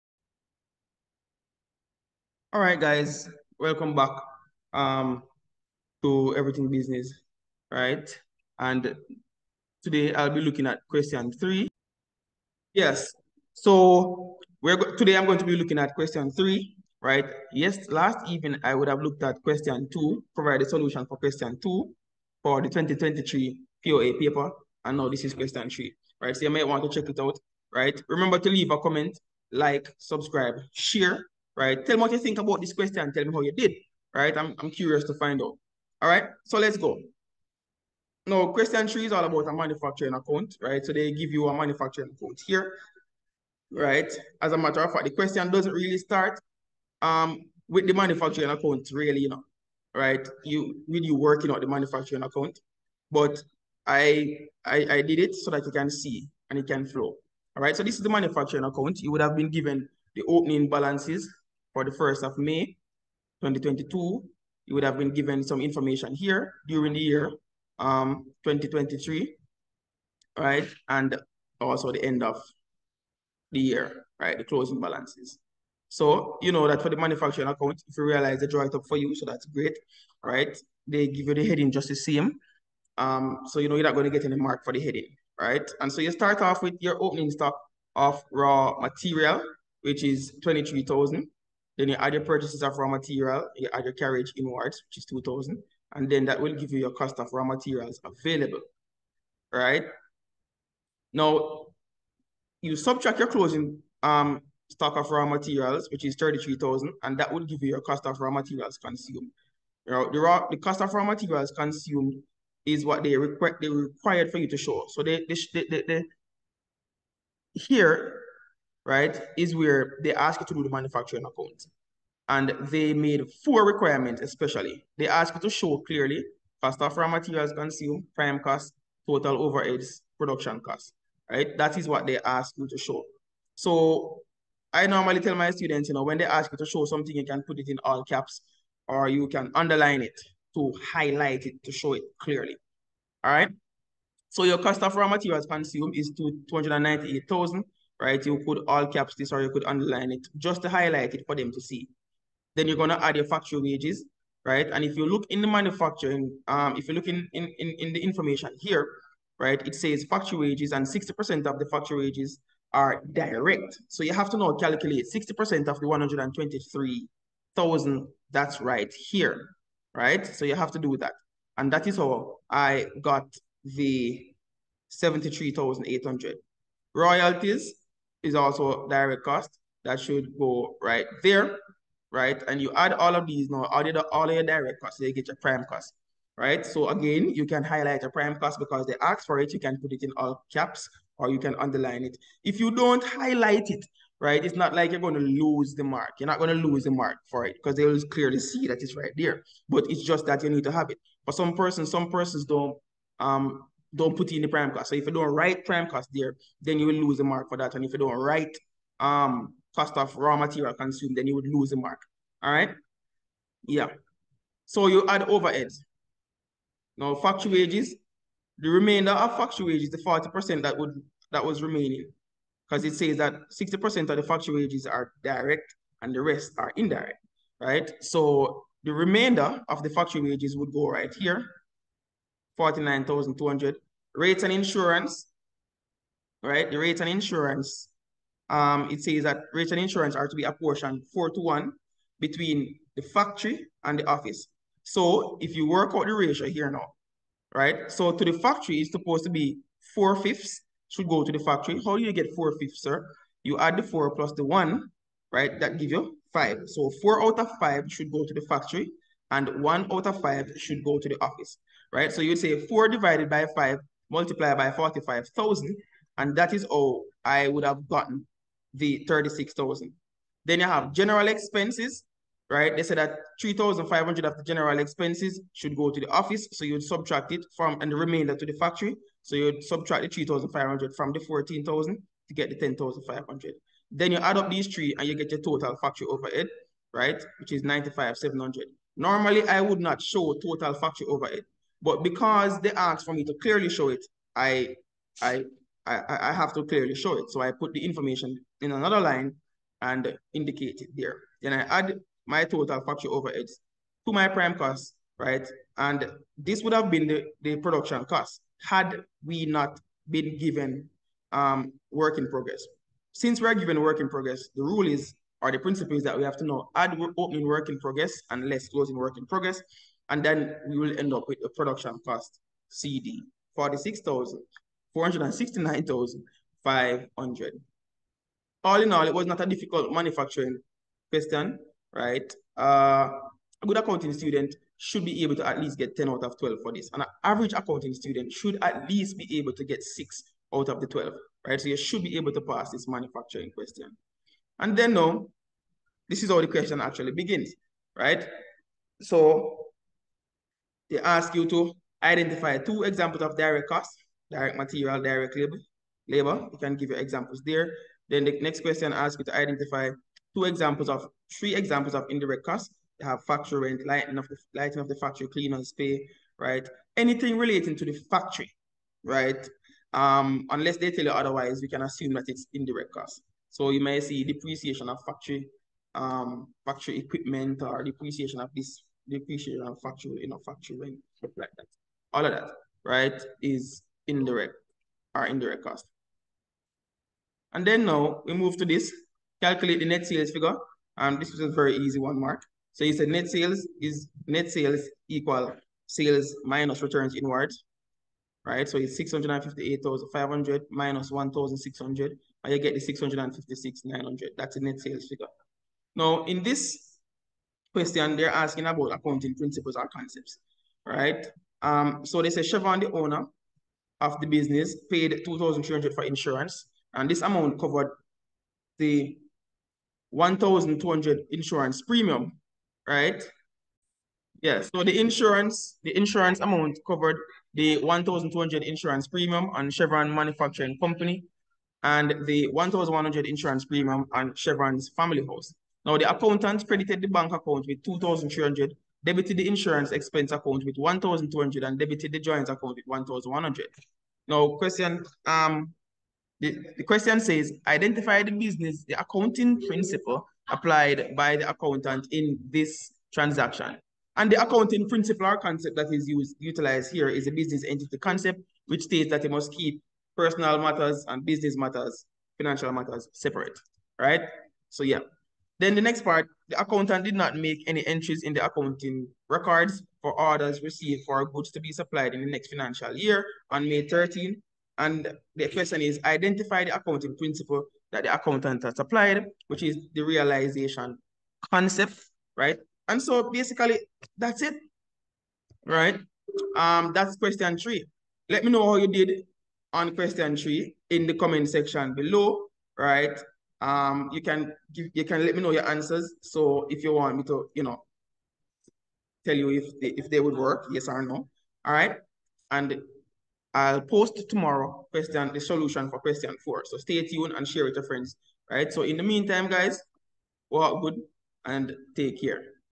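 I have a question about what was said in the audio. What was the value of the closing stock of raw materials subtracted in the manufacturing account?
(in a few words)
33,000.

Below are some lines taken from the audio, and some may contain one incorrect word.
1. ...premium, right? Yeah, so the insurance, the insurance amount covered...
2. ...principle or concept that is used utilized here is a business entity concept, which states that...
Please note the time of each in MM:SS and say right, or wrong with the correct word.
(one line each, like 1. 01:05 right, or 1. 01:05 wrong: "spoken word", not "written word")
1. 07:01 right
2. 07:34 right.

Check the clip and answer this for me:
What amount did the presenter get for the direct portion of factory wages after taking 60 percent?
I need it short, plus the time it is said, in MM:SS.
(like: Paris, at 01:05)
73,800, at 02:54.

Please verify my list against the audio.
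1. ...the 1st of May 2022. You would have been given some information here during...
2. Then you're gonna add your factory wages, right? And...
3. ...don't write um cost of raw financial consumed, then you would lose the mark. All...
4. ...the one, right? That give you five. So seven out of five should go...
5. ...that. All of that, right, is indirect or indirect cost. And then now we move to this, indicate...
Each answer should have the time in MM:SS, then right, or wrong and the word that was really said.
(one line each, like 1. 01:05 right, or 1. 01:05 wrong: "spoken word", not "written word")
1. 01:01 right
2. 02:32 right
3. 03:27 wrong: "material", not "financial"
4. 04:14 wrong: "four", not "seven"
5. 06:21 wrong: "calculate", not "indicate".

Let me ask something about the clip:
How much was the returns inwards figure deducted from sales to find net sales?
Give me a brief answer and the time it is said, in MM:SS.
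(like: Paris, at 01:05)
1,600, at 06:41.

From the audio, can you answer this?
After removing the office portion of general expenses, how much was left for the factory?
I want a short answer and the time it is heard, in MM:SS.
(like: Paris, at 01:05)
10,500, at 04:42.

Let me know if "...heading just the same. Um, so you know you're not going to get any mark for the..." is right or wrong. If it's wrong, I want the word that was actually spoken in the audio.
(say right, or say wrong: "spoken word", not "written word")
right.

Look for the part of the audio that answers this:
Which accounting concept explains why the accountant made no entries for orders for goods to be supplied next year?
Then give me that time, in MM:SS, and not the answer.
08:00.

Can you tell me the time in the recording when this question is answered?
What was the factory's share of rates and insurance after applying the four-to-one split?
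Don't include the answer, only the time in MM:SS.
04:29.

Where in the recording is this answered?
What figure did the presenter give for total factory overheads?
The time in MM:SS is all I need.
04:47.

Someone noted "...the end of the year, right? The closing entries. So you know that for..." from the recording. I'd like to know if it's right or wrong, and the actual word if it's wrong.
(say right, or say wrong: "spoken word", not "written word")
wrong: "balances", not "entries".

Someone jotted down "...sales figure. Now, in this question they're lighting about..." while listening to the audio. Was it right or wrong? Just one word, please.
wrong.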